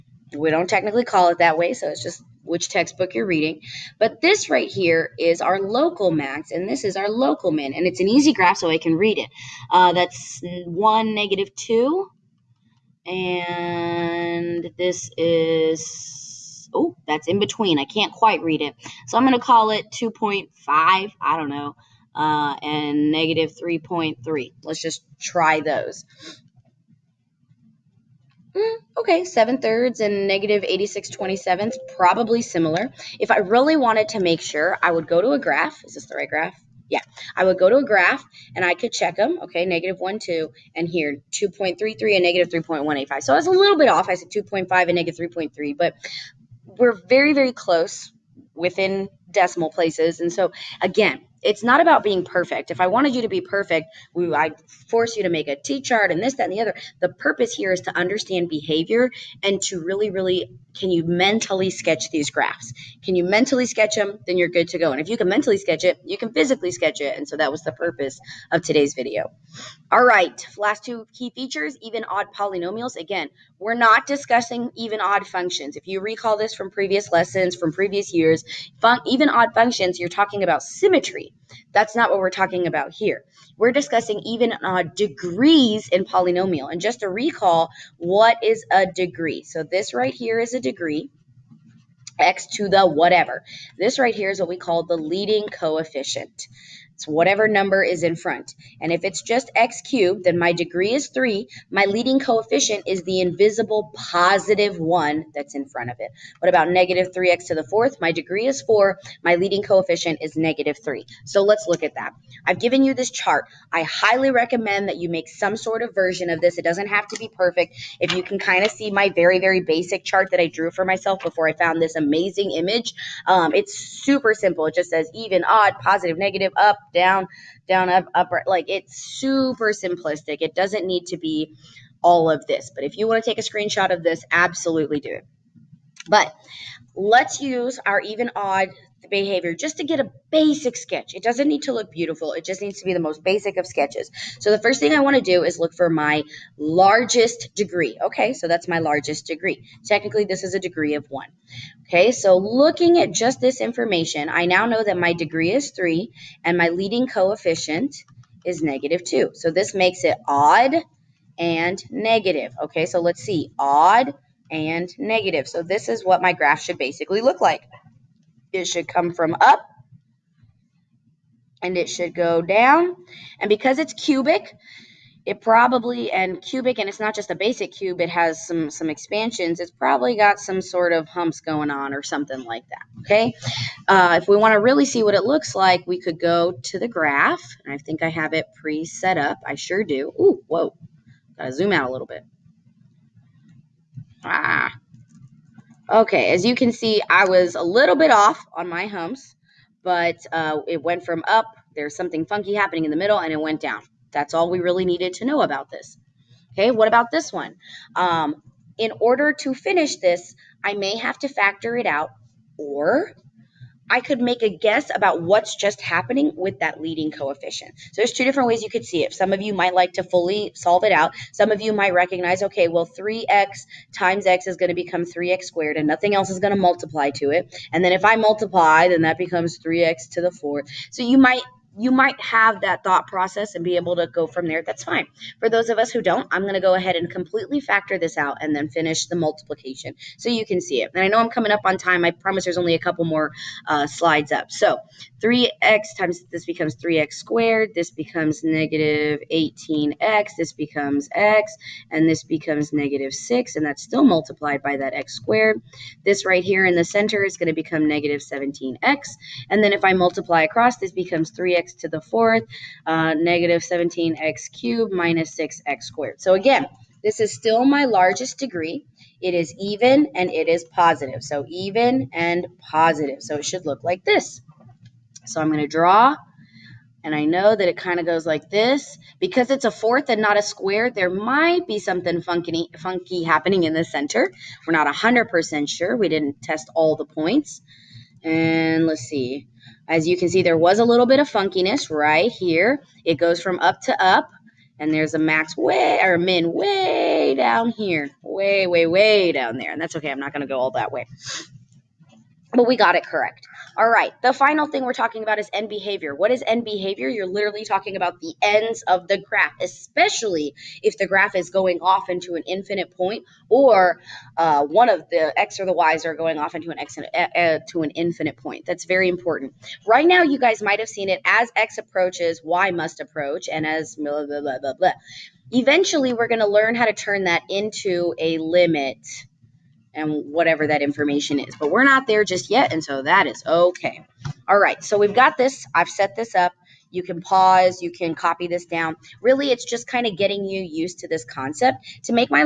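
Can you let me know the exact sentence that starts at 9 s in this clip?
Uh, that's 1, negative 2, and this is, oh, that's in between.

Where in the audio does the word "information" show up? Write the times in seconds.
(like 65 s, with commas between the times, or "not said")
153 s, 330 s.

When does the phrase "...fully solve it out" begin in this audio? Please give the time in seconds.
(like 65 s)
220 s.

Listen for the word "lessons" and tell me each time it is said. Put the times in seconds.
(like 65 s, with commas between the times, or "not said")
77 s.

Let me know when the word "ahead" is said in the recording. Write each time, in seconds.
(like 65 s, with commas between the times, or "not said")
236 s.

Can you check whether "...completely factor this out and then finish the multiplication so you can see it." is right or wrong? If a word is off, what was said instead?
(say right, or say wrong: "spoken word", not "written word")
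right.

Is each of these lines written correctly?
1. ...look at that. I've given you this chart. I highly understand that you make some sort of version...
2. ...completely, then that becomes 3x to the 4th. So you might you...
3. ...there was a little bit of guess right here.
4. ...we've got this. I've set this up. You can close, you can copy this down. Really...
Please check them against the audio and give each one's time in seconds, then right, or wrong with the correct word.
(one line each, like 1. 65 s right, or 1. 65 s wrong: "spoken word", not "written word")
1. 111 s wrong: "recommend", not "understand"
2. 228 s wrong: "multiply", not "completely"
3. 290 s wrong: "funkiness", not "guess"
4. 334 s wrong: "pause", not "close".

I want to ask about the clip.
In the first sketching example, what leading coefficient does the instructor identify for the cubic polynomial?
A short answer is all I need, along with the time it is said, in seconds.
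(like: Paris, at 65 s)
-2, at 158 s.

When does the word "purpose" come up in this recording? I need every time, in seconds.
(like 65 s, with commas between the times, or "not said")
57 s, 67 s.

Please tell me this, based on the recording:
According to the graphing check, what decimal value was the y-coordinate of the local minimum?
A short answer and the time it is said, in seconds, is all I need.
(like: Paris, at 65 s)
-3.185, at 42 s.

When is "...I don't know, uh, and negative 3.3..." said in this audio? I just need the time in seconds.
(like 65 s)
20 s.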